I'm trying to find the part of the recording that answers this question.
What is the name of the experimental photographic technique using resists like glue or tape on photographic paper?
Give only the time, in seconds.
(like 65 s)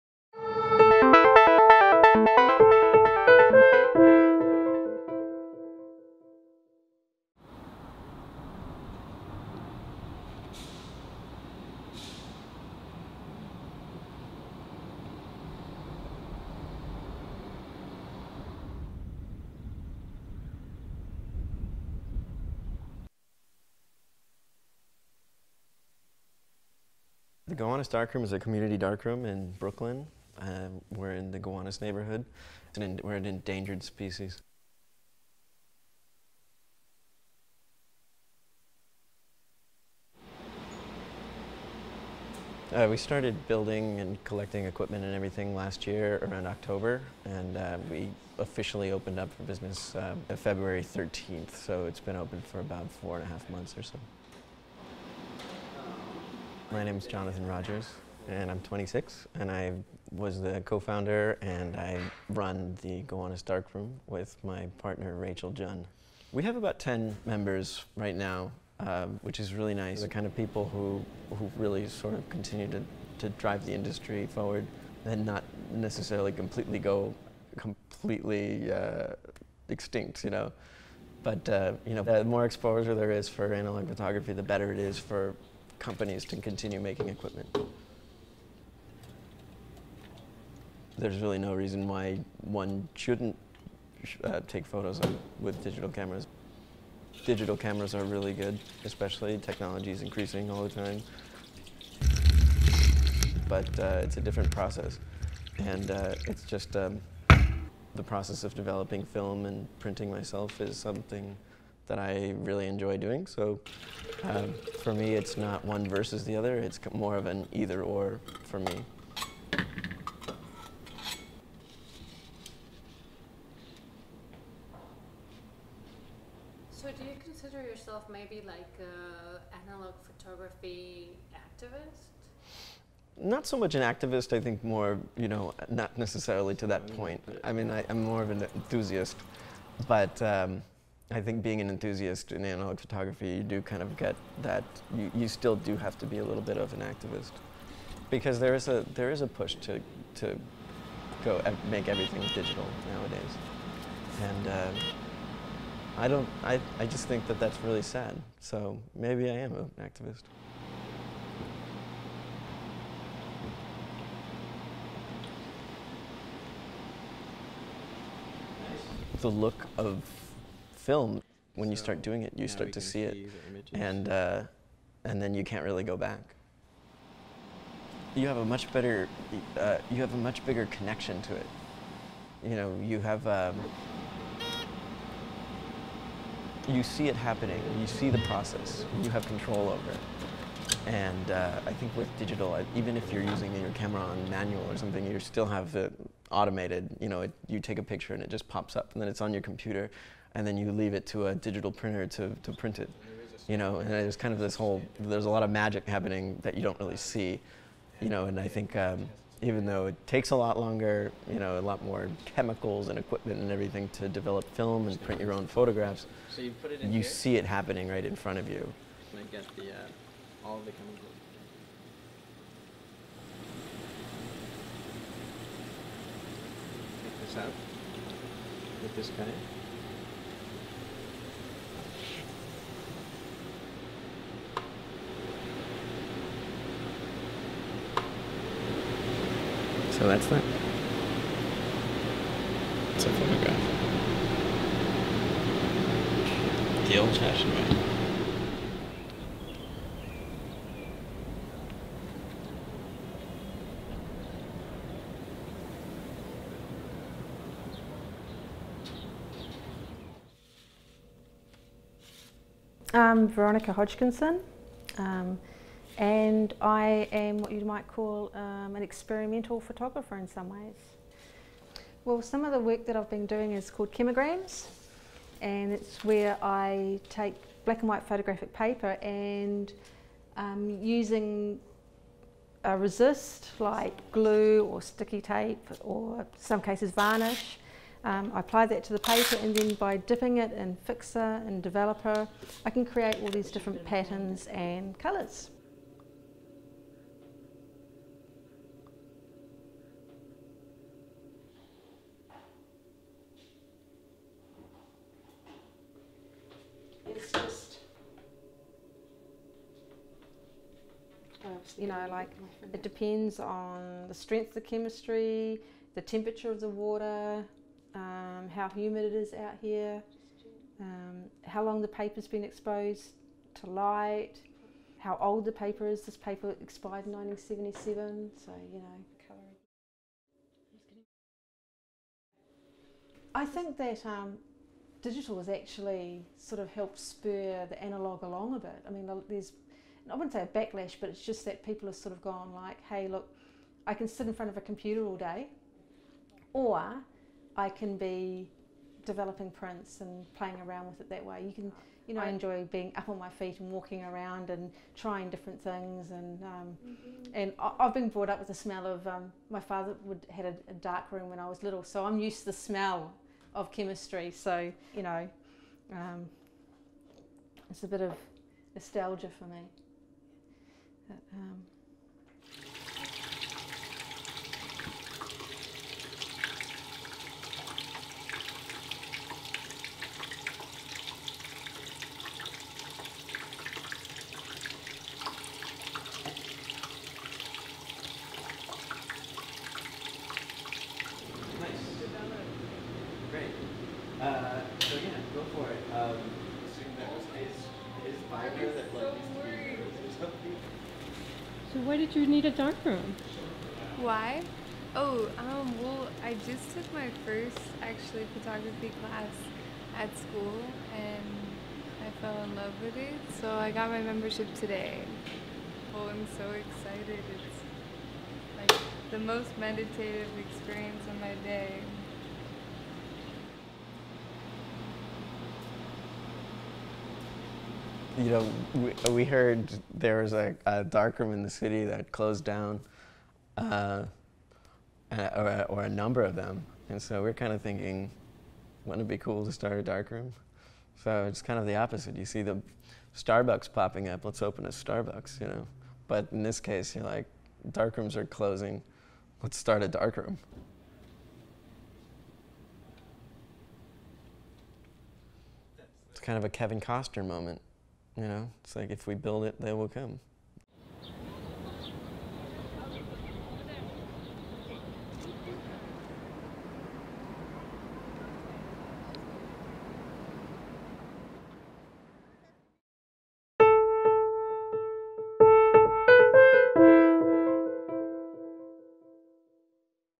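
273 s.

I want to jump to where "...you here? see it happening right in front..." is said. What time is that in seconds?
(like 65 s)
216 s.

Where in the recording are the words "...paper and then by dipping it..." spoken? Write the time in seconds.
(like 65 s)
288 s.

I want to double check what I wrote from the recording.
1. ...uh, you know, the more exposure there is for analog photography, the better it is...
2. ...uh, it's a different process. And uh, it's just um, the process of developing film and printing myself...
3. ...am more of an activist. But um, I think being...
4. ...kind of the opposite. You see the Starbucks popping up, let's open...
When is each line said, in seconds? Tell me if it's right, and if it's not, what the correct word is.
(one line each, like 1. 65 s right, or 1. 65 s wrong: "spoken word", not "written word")
1. 81 s right
2. 103 s right
3. 137 s wrong: "enthusiast", not "activist"
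4. 441 s right.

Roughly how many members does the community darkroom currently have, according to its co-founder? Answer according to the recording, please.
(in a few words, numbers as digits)
10.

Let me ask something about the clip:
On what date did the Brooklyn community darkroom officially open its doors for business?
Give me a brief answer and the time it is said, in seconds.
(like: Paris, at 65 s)
February 13th, at 50 s.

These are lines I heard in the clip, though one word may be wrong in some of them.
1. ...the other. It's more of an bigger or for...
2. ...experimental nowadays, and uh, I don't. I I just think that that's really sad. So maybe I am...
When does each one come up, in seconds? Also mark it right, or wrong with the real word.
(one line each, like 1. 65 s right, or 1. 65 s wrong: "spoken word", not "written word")
1. 116 s wrong: "either", not "bigger"
2. 152 s wrong: "digital", not "experimental".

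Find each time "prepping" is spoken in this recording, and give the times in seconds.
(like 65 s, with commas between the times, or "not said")
not said.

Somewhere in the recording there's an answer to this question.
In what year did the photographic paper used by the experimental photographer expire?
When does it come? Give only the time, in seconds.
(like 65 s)
327 s.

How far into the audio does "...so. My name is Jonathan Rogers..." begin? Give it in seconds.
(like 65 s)
53 s.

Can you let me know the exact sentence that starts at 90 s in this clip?
There's really no reason why one shouldn't uh, take photos with digital cameras.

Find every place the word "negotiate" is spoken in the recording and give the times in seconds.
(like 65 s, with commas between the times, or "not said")
not said.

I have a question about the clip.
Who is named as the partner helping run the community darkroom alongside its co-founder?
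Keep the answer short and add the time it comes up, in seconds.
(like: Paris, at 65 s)
Rachel Jun, at 65 s.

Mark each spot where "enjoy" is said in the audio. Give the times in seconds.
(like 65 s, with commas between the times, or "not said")
112 s, 352 s.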